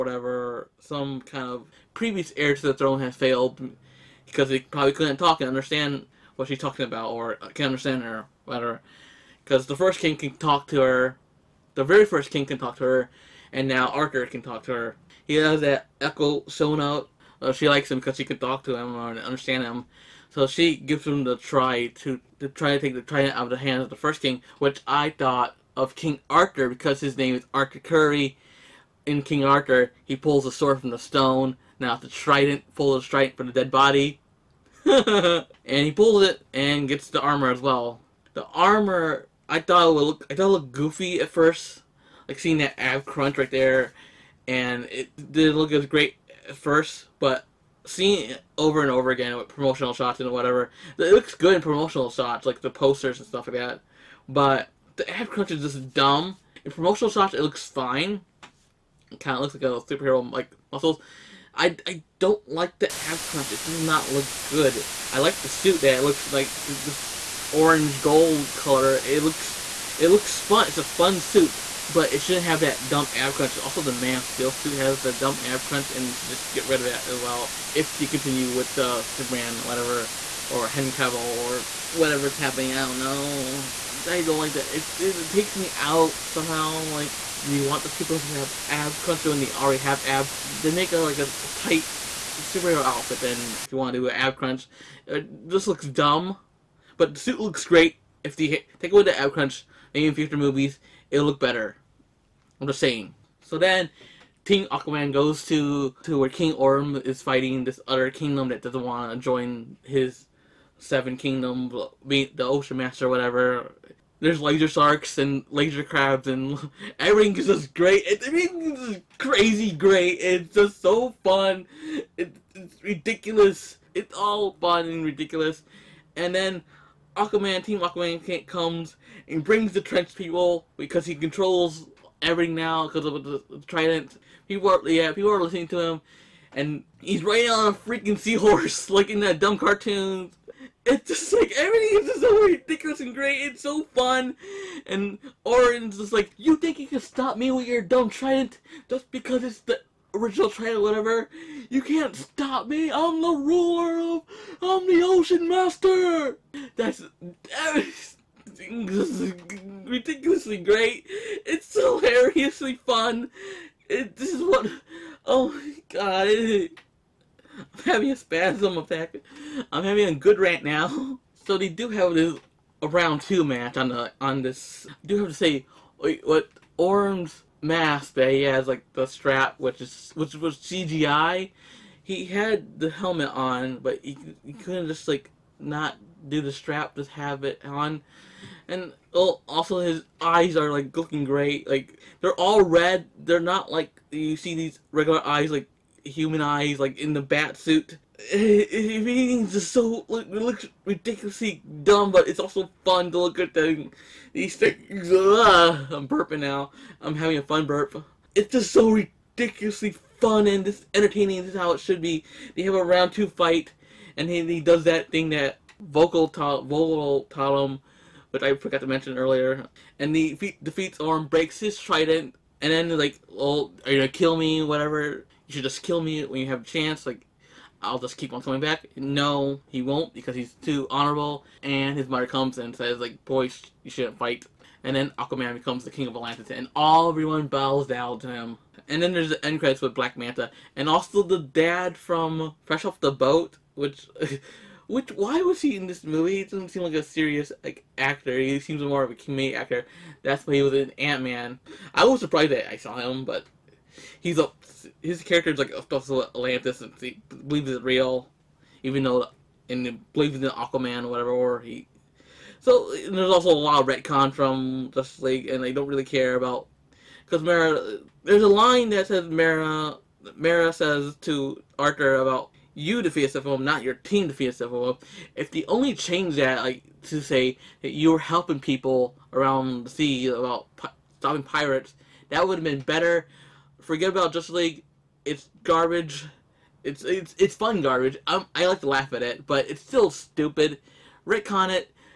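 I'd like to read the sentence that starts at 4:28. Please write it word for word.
There's a line that says Mara.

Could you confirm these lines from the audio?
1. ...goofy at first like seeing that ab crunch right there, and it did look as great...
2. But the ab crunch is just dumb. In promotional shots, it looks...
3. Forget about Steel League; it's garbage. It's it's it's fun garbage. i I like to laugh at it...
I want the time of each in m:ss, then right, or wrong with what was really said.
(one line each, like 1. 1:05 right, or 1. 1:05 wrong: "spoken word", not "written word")
1. 0:40 right
2. 0:54 right
3. 4:43 wrong: "Justice", not "Steel".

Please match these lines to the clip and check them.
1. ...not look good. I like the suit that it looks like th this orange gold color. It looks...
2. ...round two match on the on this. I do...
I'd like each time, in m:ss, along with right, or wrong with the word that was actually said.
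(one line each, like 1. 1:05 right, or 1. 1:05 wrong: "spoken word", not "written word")
1. 1:03 right
2. 2:52 right.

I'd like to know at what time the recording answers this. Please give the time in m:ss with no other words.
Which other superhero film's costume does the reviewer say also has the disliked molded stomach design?
1:13.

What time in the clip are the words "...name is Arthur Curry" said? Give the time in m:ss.
0:27.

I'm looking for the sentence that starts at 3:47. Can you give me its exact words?
Like, I'll just keep on coming back.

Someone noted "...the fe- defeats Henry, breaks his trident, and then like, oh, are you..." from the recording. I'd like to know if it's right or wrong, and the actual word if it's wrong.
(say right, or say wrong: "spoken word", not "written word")
wrong: "Orm", not "Henry".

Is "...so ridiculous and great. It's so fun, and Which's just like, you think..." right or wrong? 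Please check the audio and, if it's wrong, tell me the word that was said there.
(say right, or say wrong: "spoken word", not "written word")
wrong: "Orin", not "Which".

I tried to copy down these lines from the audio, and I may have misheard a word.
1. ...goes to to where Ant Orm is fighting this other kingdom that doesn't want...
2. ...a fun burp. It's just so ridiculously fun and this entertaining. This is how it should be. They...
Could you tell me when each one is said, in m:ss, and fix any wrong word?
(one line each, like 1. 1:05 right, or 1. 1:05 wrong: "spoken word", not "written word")
1. 1:45 wrong: "King", not "Ant"
2. 3:27 right.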